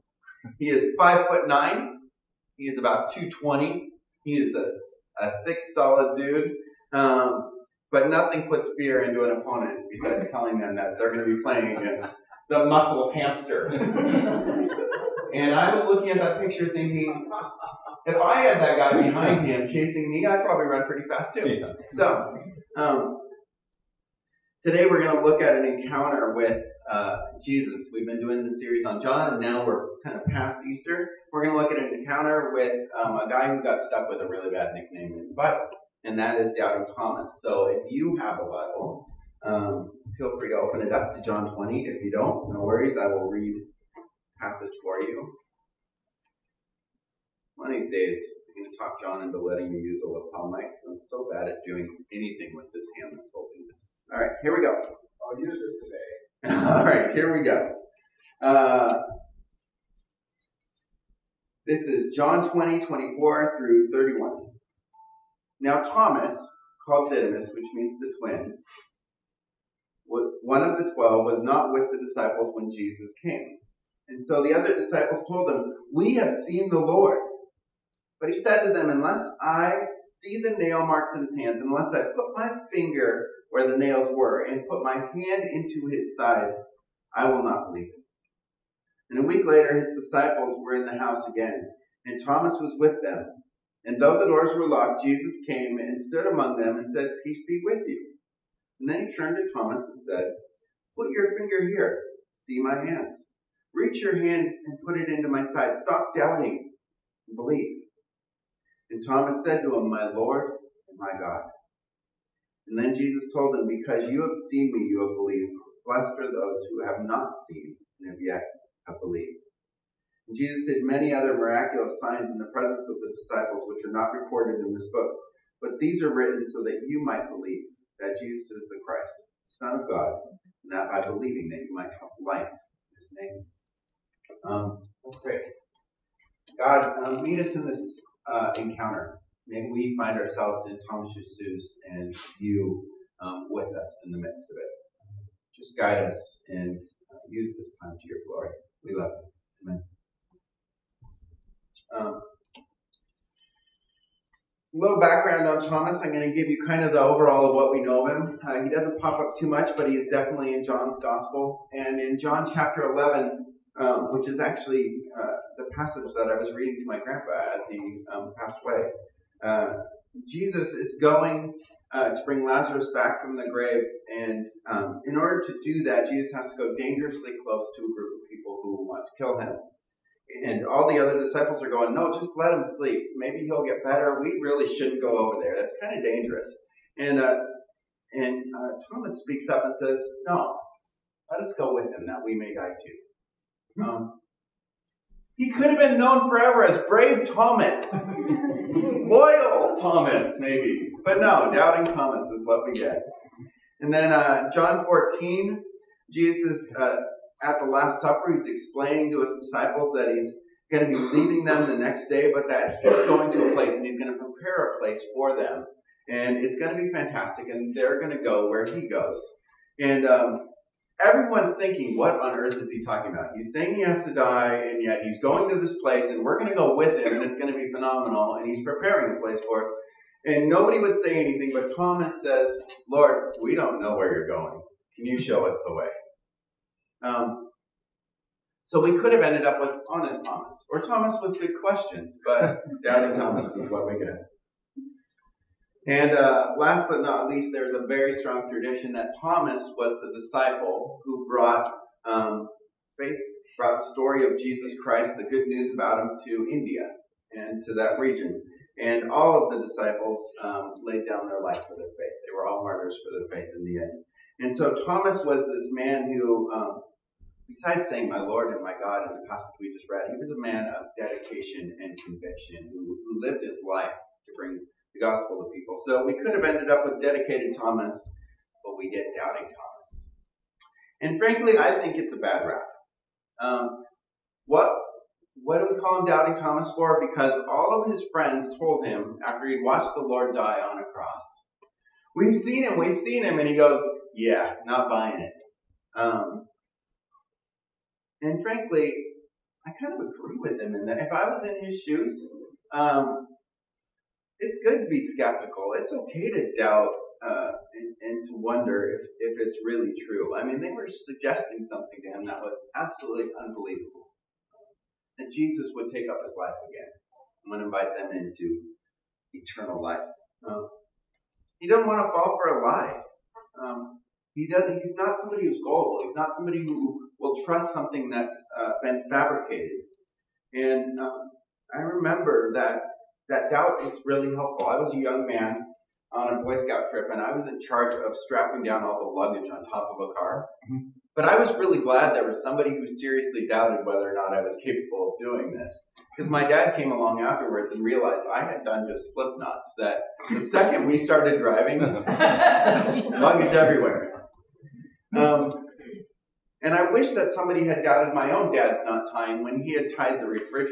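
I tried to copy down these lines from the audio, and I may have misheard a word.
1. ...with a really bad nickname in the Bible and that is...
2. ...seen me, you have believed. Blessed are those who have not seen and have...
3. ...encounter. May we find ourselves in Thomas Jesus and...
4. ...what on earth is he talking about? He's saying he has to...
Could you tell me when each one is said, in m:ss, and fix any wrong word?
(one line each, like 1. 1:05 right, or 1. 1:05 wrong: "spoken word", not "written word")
1. 0:34 right
2. 1:54 right
3. 2:18 right
4. 3:41 right.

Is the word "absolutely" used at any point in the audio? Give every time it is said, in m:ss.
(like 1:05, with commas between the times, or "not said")
5:12.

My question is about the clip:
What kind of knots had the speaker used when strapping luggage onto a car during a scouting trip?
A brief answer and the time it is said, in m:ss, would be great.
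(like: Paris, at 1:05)
slip knots, at 5:49.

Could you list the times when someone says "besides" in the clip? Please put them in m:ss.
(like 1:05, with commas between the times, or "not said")
0:09, 4:27.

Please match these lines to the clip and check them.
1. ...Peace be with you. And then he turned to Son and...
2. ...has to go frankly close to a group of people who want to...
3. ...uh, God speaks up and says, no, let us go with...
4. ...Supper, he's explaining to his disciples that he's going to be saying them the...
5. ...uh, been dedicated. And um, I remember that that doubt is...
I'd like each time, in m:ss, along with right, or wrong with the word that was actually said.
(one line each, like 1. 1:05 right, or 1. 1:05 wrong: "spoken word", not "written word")
1. 1:37 wrong: "Thomas", not "Son"
2. 2:56 wrong: "dangerously", not "frankly"
3. 3:08 wrong: "Thomas", not "God"
4. 3:28 wrong: "leaving", not "saying"
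5. 5:28 wrong: "fabricated", not "dedicated".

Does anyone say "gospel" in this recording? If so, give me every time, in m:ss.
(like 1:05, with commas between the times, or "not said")
2:41, 4:35.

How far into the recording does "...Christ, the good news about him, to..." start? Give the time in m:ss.
4:14.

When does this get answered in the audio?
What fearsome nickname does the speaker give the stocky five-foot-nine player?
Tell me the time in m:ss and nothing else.
0:12.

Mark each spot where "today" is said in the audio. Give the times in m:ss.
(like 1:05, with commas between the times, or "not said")
0:24, 0:55.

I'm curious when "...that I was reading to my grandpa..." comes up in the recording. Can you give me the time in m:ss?
2:46.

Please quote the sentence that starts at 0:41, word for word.
If you don't, no worries, I will read passage for you.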